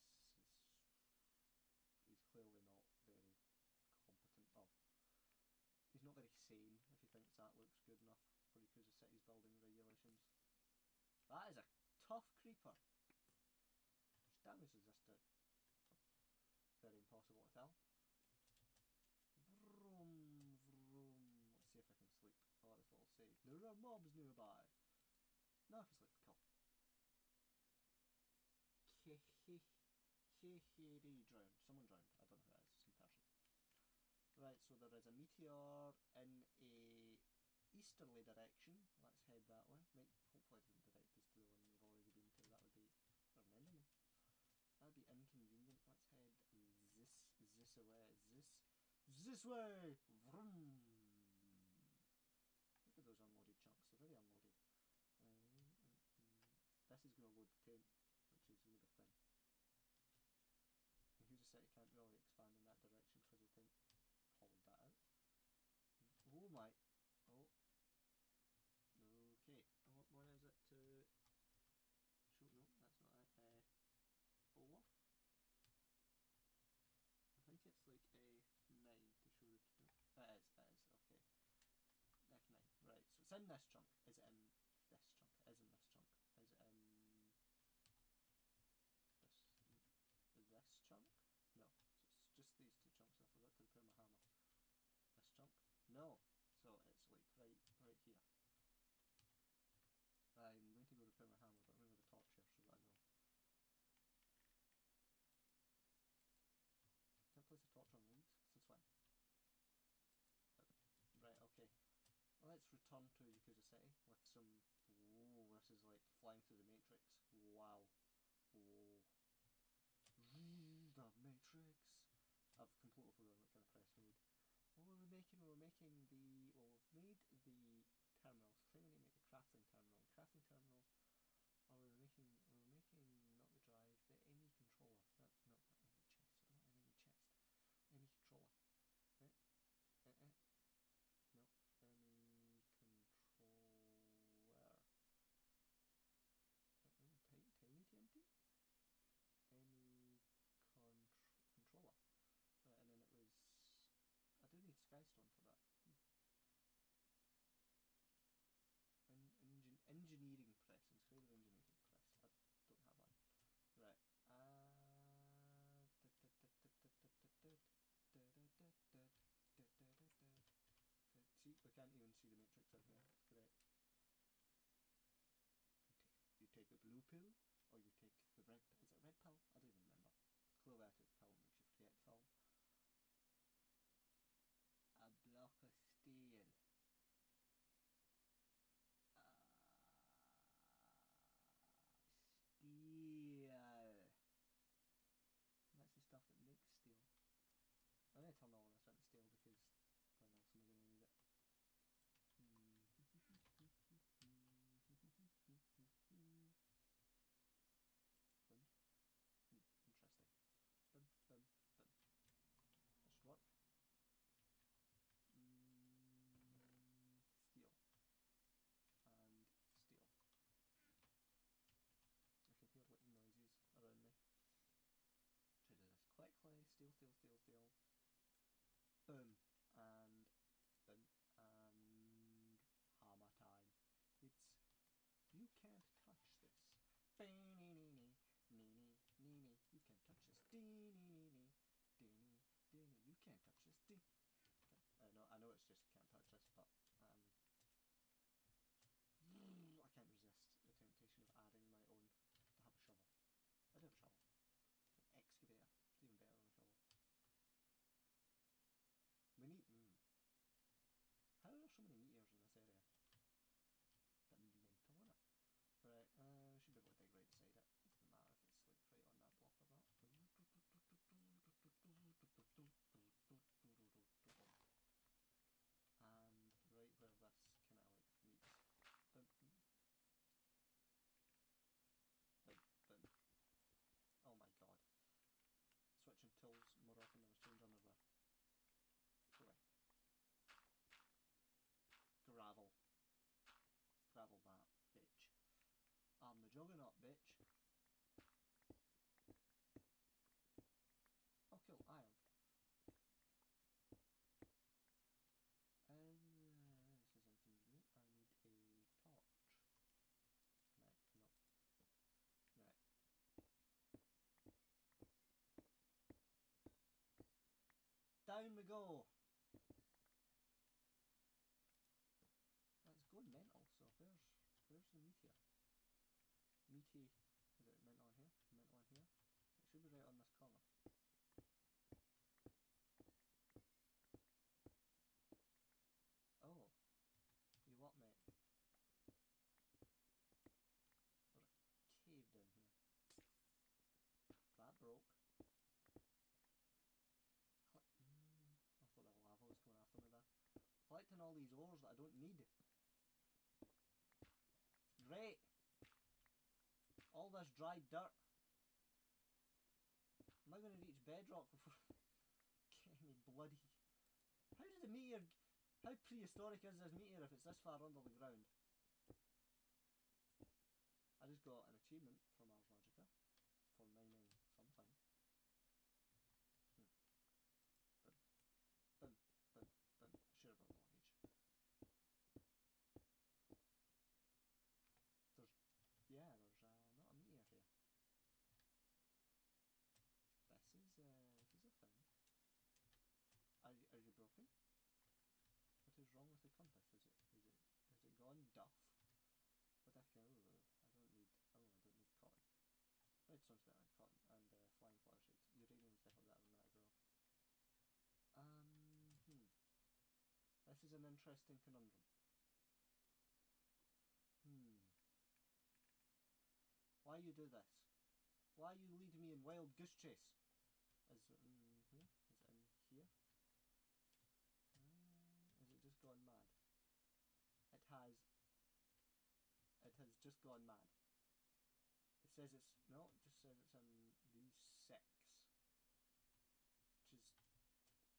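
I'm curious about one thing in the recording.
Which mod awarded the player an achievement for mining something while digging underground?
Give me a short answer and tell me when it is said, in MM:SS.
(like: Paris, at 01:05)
Ars Magica, at 06:12.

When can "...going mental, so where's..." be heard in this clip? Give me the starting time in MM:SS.
05:23.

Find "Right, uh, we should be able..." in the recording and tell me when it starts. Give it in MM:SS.
04:25.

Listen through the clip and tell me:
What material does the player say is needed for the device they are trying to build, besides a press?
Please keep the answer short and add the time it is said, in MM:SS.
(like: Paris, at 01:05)
Skystone, at 02:34.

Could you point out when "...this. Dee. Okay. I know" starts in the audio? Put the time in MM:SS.
04:03.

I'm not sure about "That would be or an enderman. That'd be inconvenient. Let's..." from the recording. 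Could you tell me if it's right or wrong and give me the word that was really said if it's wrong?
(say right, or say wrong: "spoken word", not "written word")
right.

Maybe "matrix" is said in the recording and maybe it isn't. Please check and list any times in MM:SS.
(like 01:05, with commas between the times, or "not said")
01:56, 02:01, 02:52.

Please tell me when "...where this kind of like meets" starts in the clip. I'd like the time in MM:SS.
04:36.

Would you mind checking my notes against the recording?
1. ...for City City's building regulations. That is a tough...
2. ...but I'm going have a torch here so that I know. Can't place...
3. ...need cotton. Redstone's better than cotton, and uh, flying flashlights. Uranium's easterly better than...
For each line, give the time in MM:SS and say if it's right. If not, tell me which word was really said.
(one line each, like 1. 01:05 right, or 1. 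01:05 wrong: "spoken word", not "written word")
1. 00:08 wrong: "Yakuza", not "City"
2. 01:41 right
3. 06:41 wrong: "definitely", not "easterly".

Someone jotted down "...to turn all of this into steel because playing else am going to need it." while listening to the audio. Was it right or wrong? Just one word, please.
right.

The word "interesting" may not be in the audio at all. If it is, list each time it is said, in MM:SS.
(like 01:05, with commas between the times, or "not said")
03:29, 06:51.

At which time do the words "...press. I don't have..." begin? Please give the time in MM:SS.
02:41.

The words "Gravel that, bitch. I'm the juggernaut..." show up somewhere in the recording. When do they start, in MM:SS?
04:54.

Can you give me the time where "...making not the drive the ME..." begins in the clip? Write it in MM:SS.
02:12.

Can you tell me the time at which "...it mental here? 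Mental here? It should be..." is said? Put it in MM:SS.
05:27.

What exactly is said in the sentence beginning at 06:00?
Am I going to reach bedrock before...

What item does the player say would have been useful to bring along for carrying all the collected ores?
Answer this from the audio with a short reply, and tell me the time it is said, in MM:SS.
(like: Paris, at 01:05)
luggage, at 06:20.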